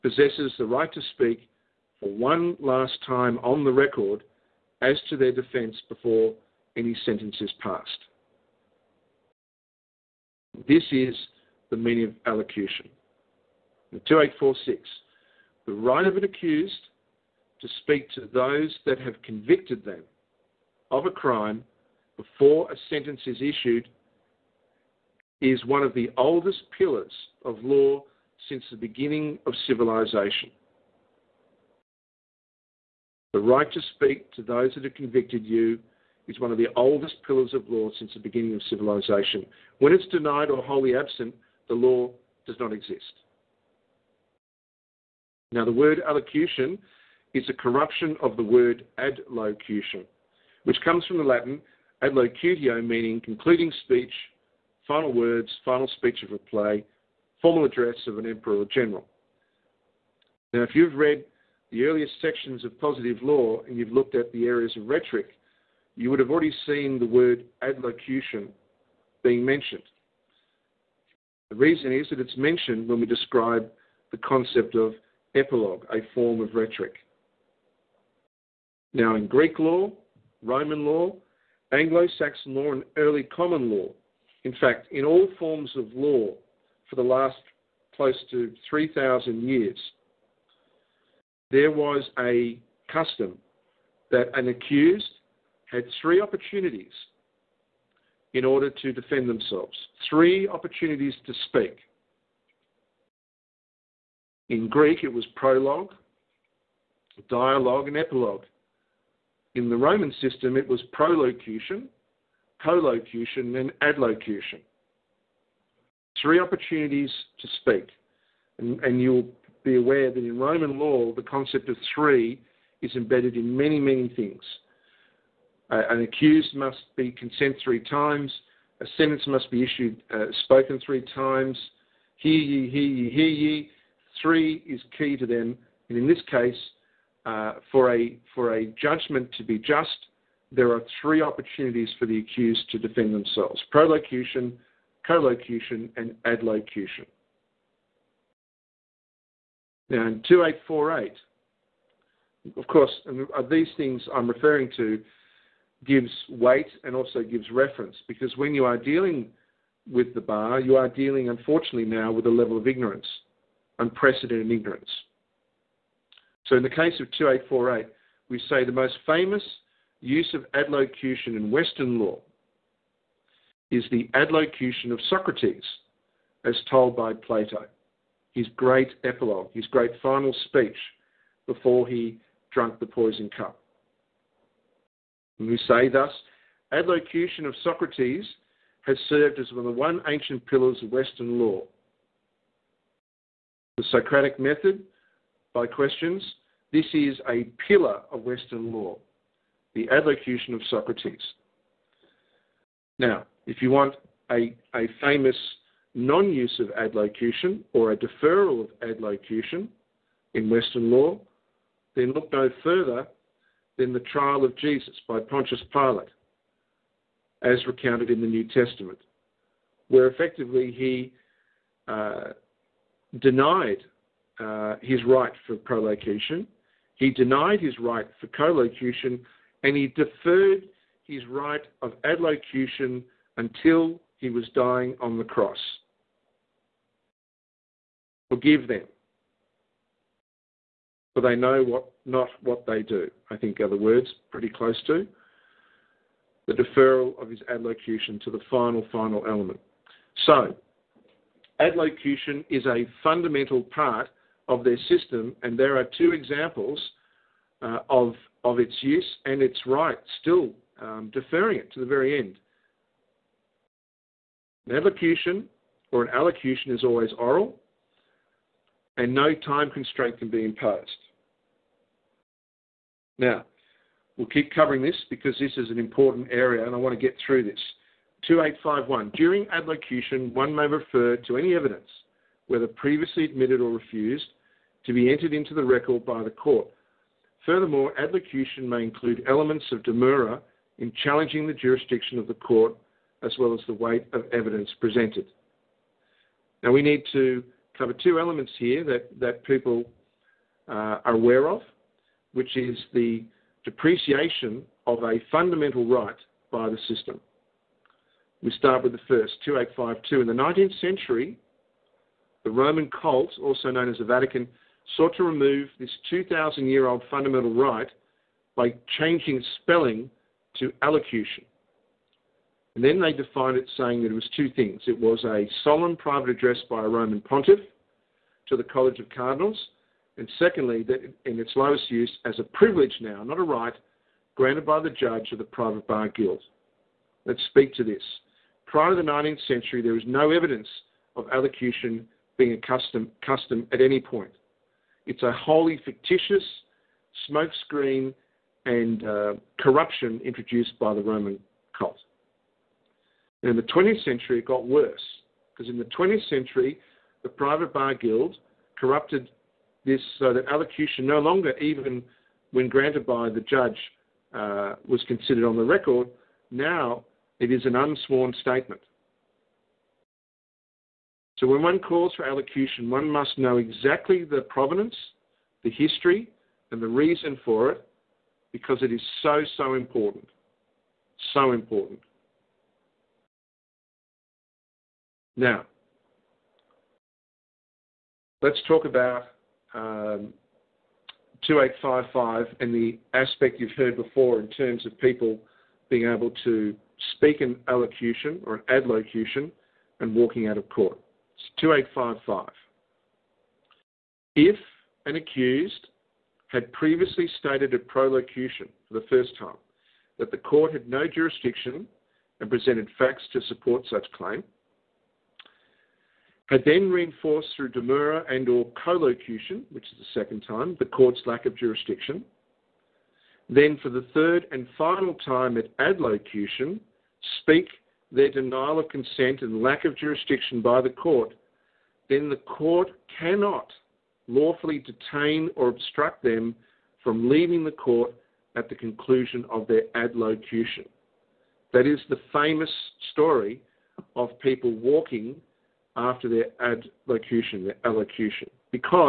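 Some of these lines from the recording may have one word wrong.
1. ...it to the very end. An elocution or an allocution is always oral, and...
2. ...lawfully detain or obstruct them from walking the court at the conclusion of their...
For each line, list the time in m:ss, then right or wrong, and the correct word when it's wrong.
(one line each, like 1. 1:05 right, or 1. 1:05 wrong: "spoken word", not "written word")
1. 4:21 right
2. 7:14 wrong: "leaving", not "walking".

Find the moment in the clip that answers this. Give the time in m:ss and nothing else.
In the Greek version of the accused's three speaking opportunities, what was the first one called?
1:45.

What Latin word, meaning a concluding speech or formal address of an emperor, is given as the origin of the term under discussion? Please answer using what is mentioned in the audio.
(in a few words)
adlocutio.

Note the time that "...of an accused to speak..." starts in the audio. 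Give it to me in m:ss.
0:16.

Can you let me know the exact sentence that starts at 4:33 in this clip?
Now, we'll keep covering this because this is an important area and I want to get through this.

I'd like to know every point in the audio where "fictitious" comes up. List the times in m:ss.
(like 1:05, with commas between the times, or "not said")
5:45.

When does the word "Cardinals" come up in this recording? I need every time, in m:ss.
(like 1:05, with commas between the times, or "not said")
5:29.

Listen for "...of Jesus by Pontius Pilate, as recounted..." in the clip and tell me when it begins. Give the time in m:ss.
3:34.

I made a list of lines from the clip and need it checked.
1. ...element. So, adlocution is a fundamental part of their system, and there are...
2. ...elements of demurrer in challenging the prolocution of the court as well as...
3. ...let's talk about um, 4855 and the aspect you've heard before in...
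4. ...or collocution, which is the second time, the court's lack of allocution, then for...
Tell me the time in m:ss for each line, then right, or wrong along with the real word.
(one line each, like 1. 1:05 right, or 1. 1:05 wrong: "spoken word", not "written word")
1. 4:09 right
2. 4:49 wrong: "jurisdiction", not "prolocution"
3. 6:28 wrong: "2855", not "4855"
4. 6:58 wrong: "jurisdiction", not "allocution".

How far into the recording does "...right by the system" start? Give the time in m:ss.
5:05.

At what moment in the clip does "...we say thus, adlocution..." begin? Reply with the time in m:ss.
3:05.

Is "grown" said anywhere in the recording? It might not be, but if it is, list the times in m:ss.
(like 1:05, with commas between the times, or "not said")
not said.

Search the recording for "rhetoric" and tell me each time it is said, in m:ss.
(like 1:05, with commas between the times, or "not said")
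1:04, 1:16.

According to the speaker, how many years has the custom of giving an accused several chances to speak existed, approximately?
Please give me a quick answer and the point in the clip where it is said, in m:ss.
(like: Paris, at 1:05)
close to 3,000 years, at 1:27.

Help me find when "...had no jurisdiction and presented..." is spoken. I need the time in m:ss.
6:50.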